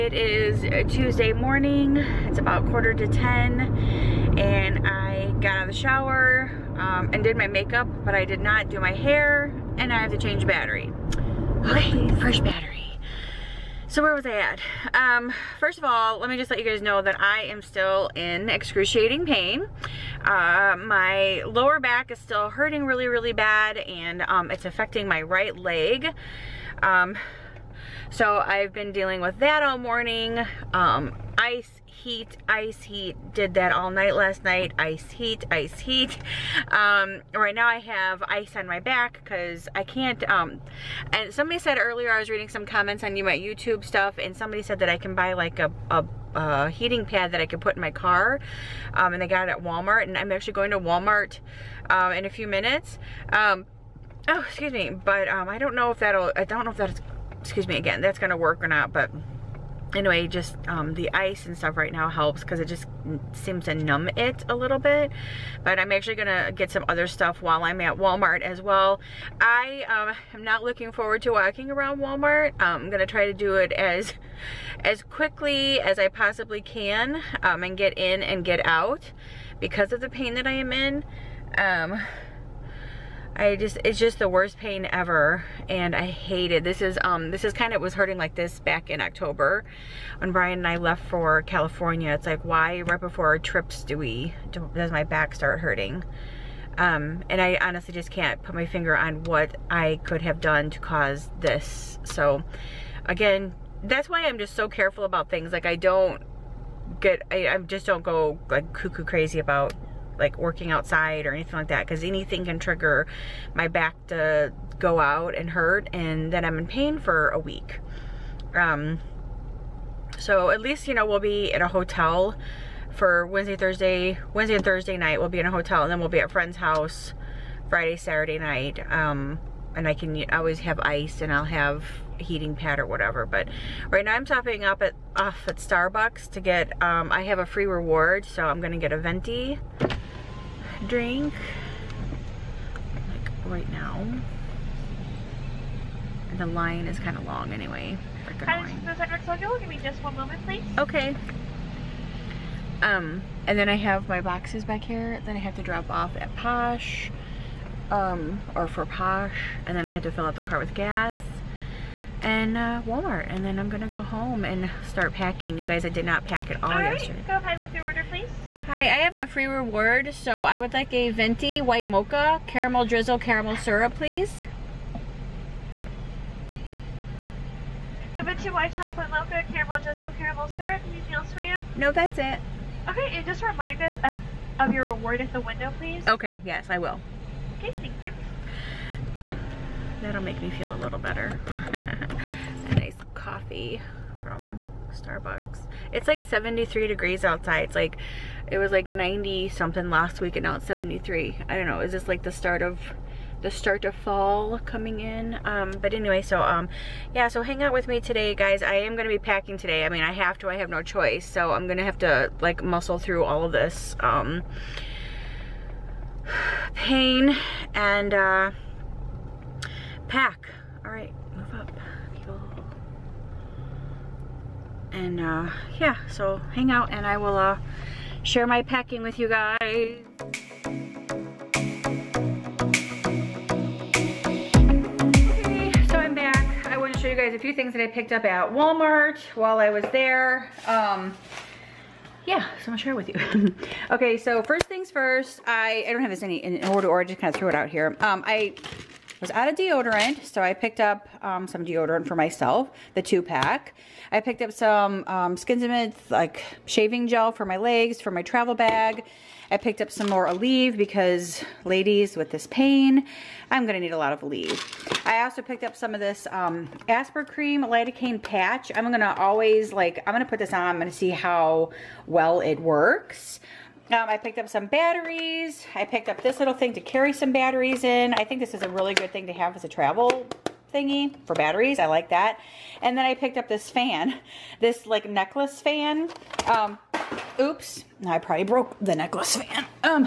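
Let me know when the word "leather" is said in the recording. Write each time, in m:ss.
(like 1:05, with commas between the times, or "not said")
not said.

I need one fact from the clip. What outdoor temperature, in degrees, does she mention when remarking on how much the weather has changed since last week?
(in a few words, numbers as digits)
73.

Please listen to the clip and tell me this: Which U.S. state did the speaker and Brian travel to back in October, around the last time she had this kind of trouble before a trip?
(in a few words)
California.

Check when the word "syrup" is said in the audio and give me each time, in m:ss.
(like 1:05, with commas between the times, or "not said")
2:53, 3:00.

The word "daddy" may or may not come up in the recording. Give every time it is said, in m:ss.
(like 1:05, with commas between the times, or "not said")
not said.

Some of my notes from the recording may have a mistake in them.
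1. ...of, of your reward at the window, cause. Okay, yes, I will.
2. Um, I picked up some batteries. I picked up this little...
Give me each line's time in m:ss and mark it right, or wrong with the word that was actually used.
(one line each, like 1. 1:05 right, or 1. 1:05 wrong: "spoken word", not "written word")
1. 3:04 wrong: "please", not "cause"
2. 4:33 right.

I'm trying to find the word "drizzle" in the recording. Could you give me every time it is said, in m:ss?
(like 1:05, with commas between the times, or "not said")
2:52, 2:59.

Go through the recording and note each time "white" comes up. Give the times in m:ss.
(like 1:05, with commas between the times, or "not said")
2:51, 2:58.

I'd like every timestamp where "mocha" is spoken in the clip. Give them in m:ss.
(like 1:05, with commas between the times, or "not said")
2:51, 2:59.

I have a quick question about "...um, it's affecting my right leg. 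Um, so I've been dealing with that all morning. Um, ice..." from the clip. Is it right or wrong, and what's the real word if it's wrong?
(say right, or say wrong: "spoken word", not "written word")
right.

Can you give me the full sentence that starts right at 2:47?
Go ahead with your order, please.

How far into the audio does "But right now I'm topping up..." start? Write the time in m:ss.
2:13.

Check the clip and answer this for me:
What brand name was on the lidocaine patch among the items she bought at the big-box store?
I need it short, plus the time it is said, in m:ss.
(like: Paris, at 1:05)
Aspercreme, at 4:26.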